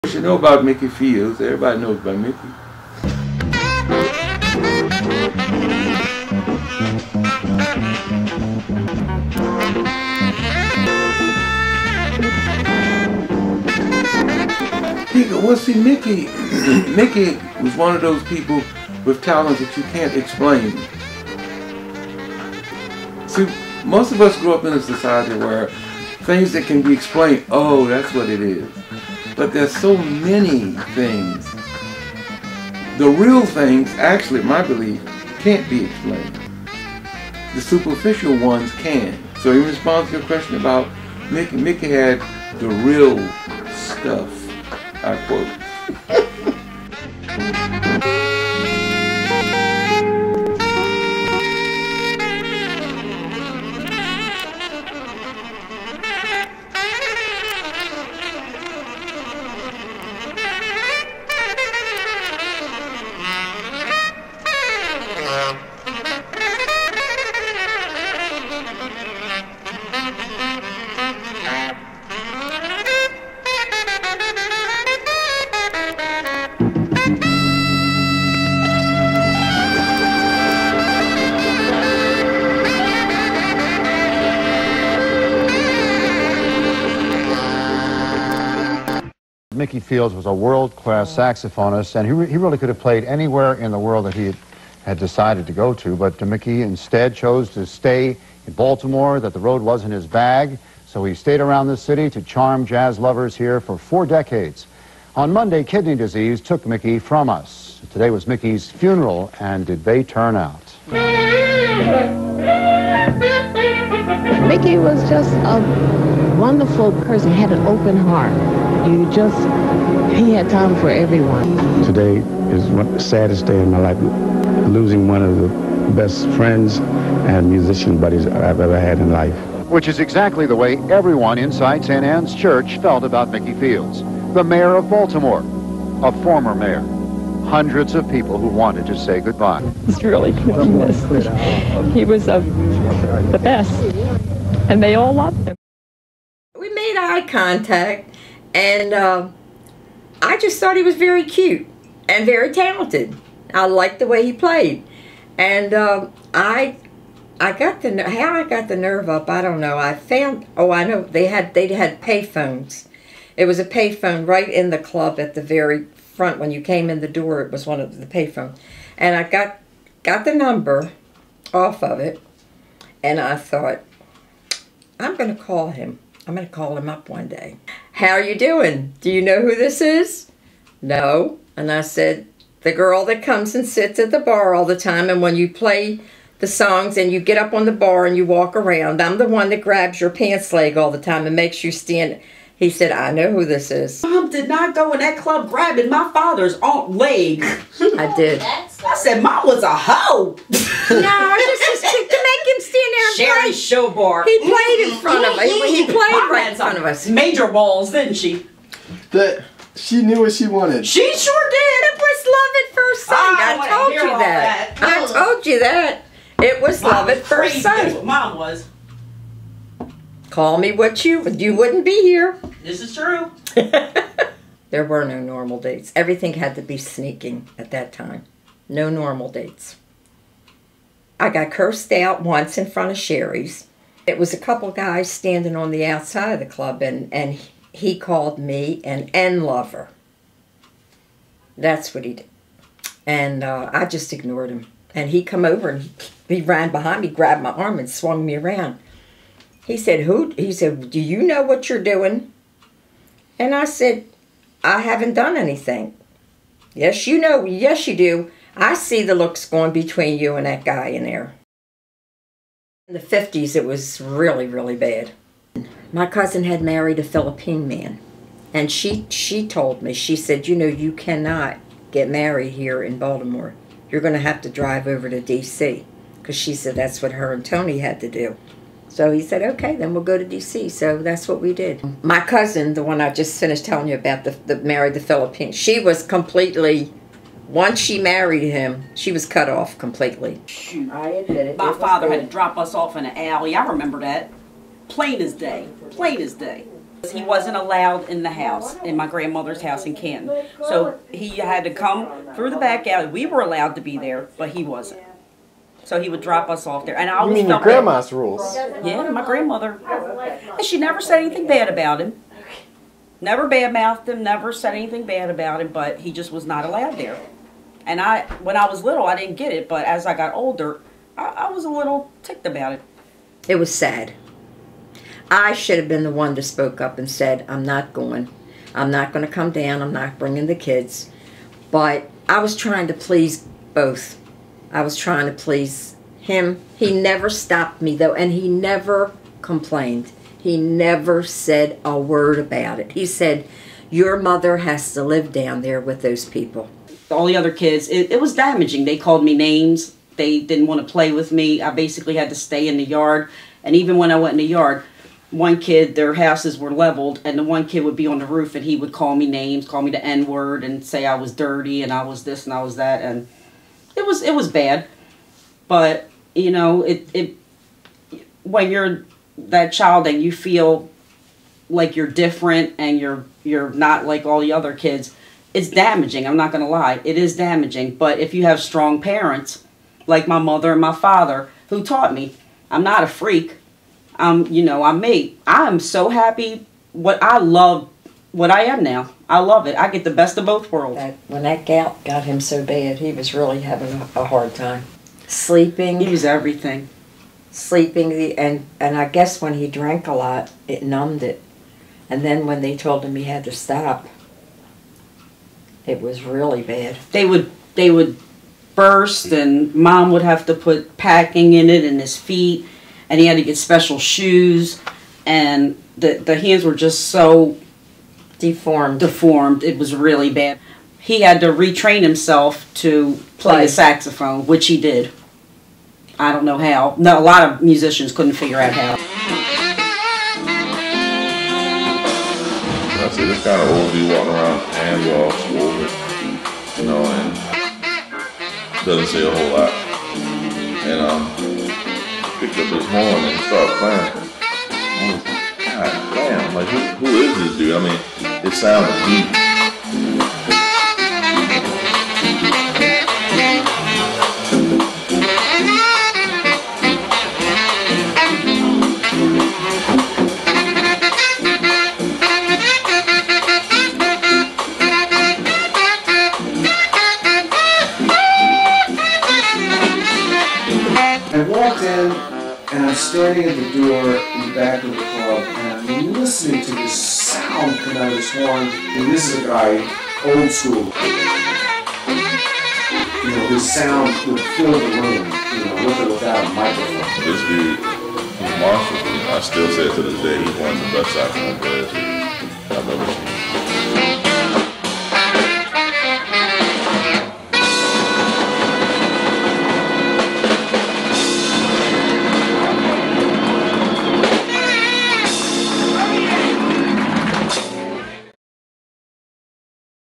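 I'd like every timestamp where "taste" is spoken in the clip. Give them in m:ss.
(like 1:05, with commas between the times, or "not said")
not said.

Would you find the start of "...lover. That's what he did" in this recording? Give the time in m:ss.
3:59.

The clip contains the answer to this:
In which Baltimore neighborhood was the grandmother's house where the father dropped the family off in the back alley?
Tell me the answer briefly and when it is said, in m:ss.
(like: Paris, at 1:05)
Canton, at 4:59.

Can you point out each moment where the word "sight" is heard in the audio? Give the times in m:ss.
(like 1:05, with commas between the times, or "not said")
3:33, 3:37.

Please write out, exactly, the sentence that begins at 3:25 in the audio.
played right in front of us.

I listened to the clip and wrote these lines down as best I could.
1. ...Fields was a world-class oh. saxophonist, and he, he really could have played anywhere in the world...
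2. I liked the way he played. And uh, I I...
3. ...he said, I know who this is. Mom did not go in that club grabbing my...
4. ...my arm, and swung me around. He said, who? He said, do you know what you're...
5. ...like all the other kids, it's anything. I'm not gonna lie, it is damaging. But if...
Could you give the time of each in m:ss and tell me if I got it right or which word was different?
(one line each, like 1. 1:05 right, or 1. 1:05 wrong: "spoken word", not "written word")
1. 1:29 right
2. 2:33 right
3. 3:12 right
4. 4:07 right
5. 6:14 wrong: "damaging", not "anything".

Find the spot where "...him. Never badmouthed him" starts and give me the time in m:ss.
5:12.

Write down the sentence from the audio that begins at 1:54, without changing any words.
Mickey was just a wonderful person, He had an open heart.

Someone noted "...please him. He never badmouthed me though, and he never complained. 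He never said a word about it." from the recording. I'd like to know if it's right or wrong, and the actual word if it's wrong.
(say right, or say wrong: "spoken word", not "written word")
wrong: "stopped", not "badmouthed".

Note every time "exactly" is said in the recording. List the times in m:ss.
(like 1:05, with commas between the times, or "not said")
2:09.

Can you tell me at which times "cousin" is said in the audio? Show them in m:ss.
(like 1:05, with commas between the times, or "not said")
4:26, 4:42.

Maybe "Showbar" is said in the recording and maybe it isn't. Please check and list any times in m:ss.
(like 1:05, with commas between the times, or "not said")
3:23.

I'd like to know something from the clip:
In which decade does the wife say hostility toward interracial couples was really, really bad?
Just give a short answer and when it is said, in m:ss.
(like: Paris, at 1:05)
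1950s, at 4:22.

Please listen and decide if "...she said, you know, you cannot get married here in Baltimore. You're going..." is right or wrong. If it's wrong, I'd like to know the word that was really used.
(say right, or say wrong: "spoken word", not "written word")
right.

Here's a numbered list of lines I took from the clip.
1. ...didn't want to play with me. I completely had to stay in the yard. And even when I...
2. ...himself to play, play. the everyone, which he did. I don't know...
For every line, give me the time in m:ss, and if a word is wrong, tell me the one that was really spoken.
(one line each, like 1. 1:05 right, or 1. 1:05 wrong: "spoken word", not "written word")
1. 5:50 wrong: "basically", not "completely"
2. 7:02 wrong: "saxophone", not "everyone".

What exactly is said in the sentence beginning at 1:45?
On Monday, kidney disease took Mickey from us.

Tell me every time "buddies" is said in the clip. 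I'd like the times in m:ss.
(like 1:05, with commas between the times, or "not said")
2:08.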